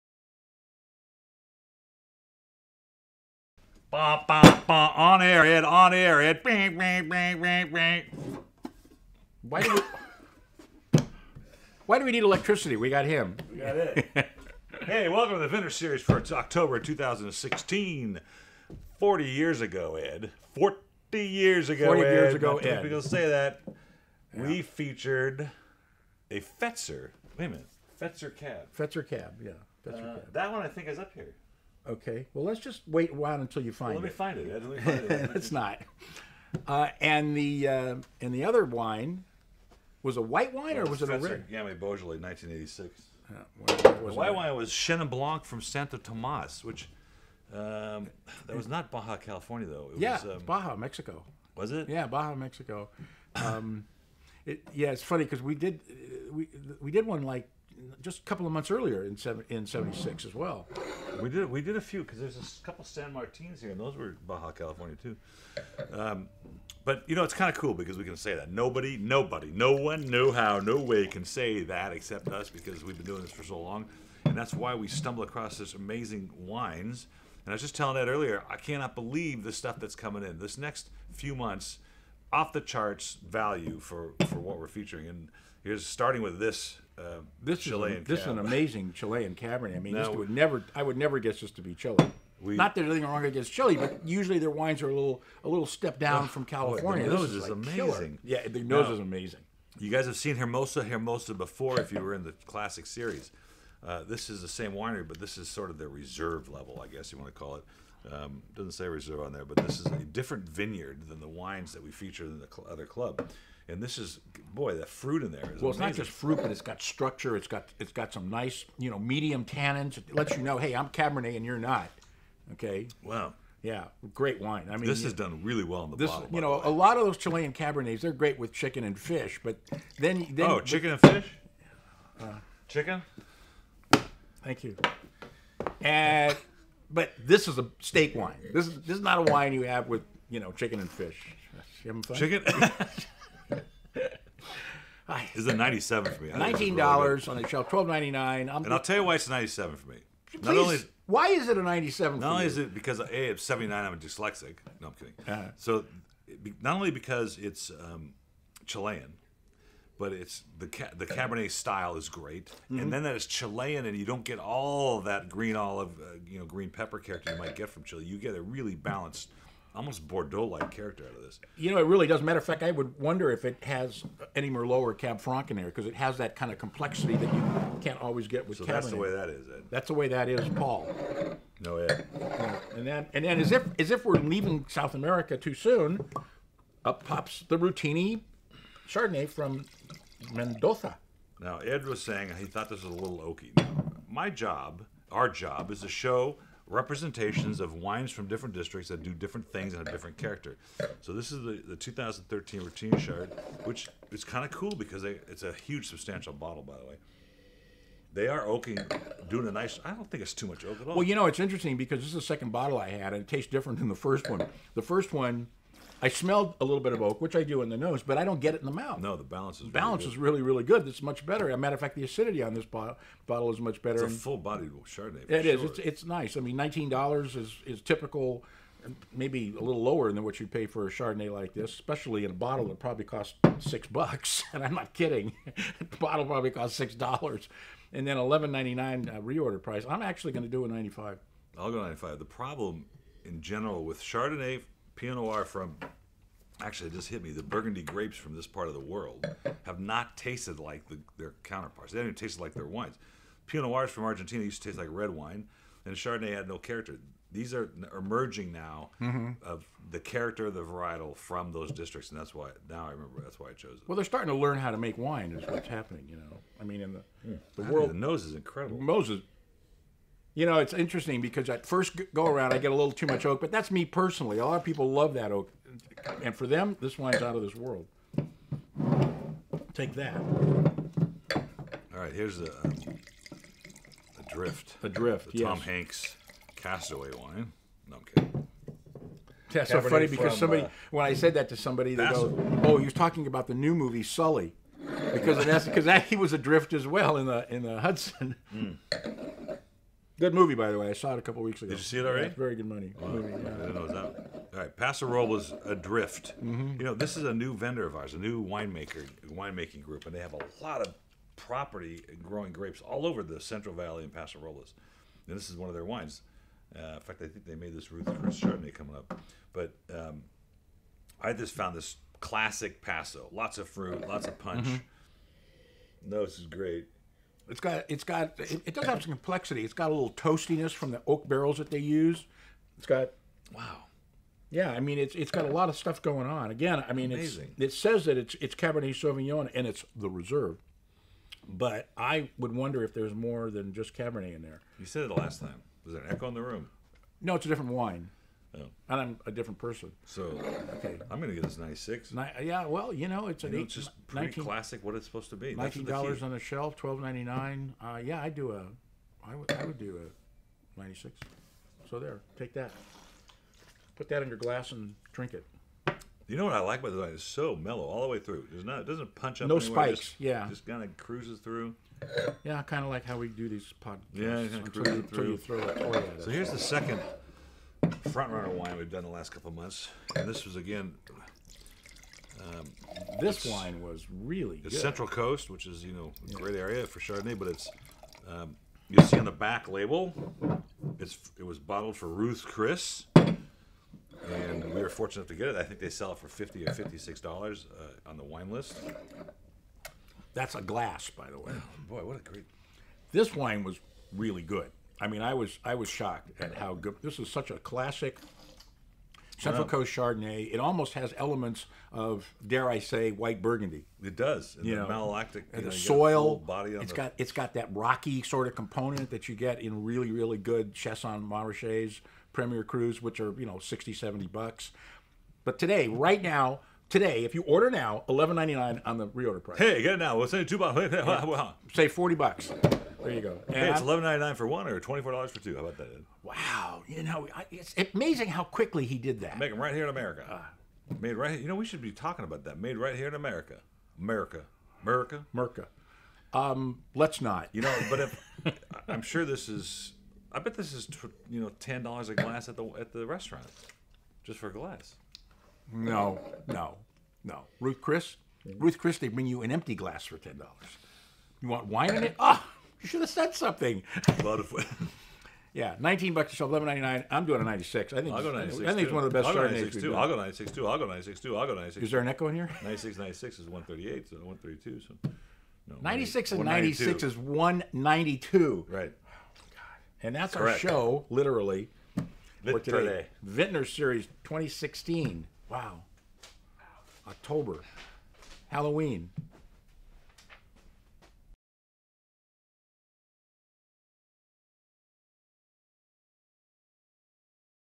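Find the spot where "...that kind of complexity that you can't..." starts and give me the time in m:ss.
2:56.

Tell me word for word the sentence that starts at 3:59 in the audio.
I'm actually going to do a ninety five.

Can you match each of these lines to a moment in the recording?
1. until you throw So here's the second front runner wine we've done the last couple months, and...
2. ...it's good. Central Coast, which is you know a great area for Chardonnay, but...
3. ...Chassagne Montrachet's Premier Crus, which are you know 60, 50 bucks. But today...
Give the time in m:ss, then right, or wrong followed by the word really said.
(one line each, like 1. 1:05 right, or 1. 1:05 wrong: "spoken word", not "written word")
1. 6:15 right
2. 6:24 right
3. 7:00 wrong: "70", not "50".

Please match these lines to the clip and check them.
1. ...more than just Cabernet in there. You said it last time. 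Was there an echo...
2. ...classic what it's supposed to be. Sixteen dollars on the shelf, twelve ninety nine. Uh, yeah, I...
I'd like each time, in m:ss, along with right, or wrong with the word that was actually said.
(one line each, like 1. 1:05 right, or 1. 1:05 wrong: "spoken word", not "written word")
1. 5:43 right
2. 5:54 wrong: "Nineteen", not "Sixteen".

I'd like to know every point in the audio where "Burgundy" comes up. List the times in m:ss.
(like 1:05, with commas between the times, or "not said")
4:07, 6:53.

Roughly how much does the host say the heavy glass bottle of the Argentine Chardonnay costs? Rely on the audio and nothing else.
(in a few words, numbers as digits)
6 dollars.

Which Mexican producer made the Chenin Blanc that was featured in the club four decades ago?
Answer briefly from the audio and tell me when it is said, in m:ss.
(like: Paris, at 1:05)
Santo Tomas, at 0:45.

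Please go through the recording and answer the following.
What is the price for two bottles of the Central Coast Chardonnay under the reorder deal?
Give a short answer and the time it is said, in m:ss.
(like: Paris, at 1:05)
24 dollars, at 7:14.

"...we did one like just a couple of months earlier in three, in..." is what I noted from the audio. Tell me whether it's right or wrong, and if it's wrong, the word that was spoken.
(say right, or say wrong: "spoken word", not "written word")
wrong: "seven", not "three".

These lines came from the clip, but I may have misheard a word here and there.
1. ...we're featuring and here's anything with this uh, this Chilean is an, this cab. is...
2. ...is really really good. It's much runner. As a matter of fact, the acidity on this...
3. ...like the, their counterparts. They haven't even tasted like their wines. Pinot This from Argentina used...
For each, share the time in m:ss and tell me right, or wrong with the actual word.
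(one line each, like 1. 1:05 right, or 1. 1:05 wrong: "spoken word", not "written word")
1. 1:24 wrong: "starting", not "anything"
2. 3:40 wrong: "better", not "runner"
3. 4:10 wrong: "Noirs", not "This".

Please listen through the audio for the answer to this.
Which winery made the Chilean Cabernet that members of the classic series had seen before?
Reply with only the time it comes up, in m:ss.
1:40.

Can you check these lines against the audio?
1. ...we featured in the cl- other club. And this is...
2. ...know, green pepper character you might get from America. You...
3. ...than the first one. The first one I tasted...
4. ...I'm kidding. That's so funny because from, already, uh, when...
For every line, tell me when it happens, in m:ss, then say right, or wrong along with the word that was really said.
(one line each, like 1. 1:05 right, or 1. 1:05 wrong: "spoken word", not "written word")
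1. 1:51 right
2. 2:46 wrong: "Chile", not "America"
3. 3:33 wrong: "smelled", not "tasted"
4. 4:47 wrong: "somebody", not "already".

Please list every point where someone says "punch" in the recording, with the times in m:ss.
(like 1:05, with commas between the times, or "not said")
5:24, 6:09.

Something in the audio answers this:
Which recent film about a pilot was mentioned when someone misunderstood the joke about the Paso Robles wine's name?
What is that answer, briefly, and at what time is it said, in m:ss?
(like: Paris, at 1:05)
Sully, at 4:54.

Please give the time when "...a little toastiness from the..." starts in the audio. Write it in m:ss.
5:29.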